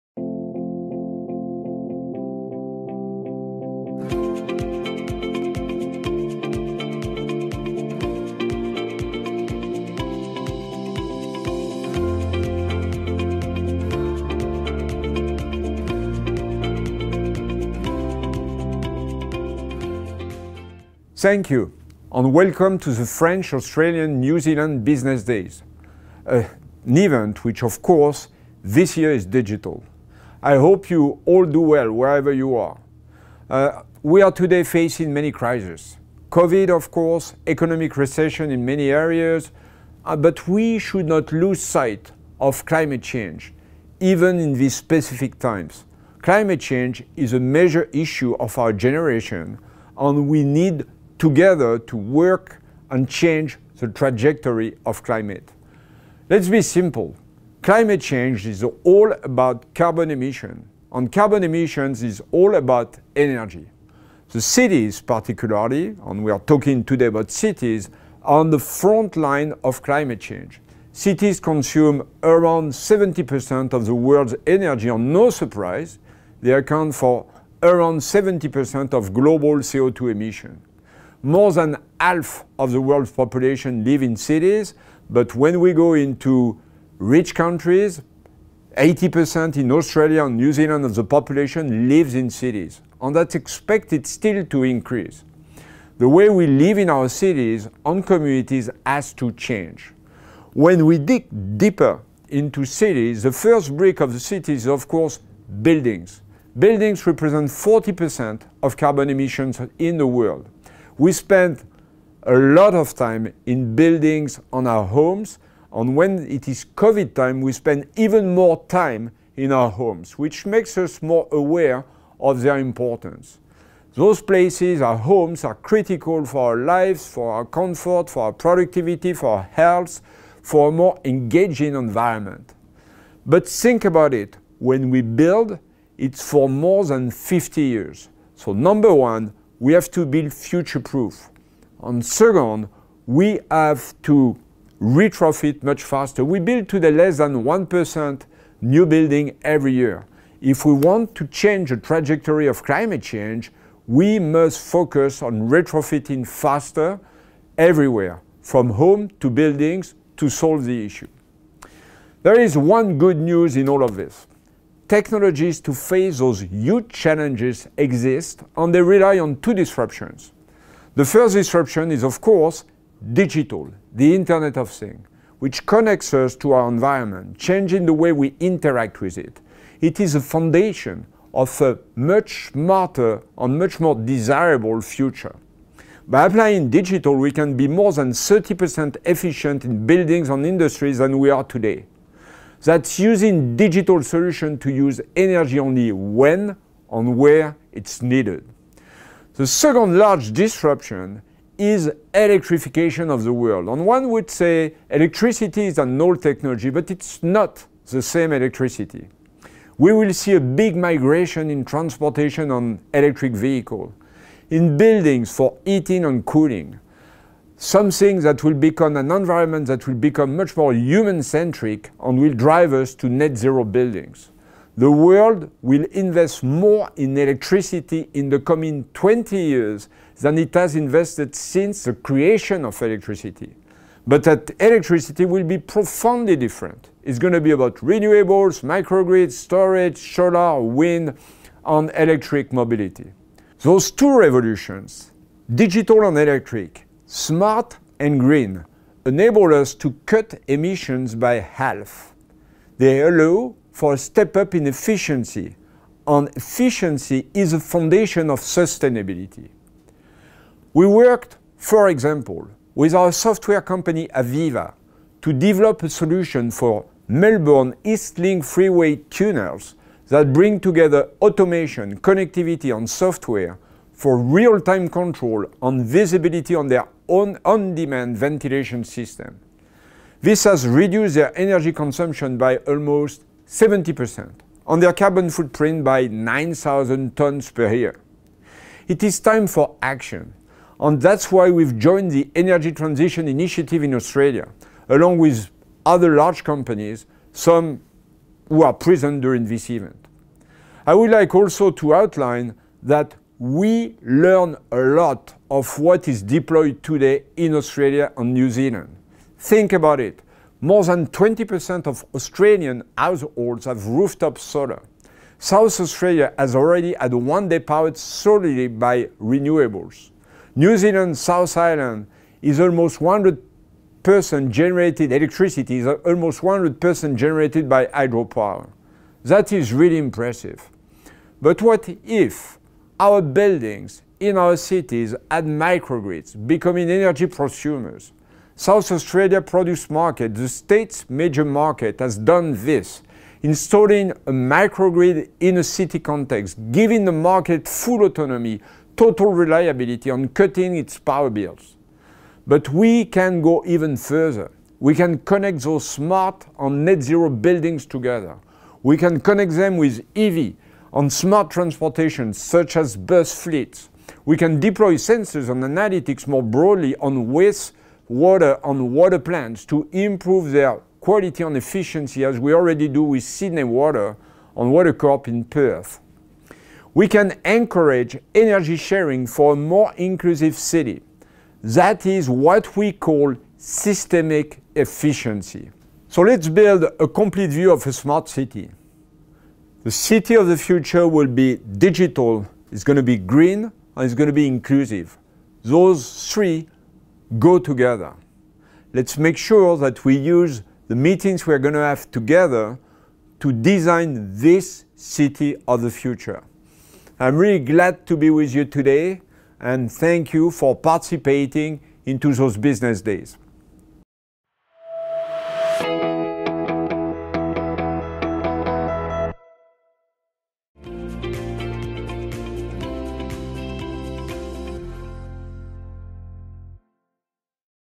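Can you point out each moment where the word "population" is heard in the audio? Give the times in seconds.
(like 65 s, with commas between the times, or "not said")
83 s, 91 s.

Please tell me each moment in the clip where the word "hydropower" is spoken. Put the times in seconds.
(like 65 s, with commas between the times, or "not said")
327 s.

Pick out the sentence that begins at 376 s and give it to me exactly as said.
We can encourage energy sharing for a more inclusive city.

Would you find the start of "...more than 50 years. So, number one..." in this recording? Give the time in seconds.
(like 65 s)
136 s.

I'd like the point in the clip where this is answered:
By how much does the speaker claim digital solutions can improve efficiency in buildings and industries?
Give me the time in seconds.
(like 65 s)
187 s.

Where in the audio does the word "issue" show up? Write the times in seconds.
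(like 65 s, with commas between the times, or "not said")
47 s, 160 s.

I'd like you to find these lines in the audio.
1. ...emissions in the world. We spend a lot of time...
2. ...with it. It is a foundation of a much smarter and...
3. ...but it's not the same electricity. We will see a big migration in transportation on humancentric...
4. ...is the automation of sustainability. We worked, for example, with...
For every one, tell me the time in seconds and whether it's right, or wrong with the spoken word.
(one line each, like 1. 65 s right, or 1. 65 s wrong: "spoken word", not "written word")
1. 109 s right
2. 178 s right
3. 206 s wrong: "electric", not "humancentric"
4. 257 s wrong: "foundation", not "automation".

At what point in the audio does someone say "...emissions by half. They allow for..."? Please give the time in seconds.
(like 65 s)
250 s.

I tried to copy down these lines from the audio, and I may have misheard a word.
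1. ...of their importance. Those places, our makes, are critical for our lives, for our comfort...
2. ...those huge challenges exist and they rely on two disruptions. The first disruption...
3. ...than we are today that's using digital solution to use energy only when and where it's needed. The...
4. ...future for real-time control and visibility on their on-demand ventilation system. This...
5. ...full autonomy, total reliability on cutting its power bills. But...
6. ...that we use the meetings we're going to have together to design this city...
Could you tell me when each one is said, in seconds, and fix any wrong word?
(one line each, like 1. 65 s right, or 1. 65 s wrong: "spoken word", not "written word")
1. 122 s wrong: "homes", not "makes"
2. 166 s right
3. 190 s right
4. 272 s wrong: "software", not "future"
5. 347 s right
6. 399 s right.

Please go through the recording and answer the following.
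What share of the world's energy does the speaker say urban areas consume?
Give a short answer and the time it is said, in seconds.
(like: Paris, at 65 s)
70%, at 72 s.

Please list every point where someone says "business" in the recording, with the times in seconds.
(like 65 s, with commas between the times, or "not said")
24 s, 412 s.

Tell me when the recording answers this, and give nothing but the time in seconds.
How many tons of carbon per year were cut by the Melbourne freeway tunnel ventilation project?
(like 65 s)
286 s.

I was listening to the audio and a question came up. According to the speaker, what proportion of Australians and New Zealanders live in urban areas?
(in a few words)
80%.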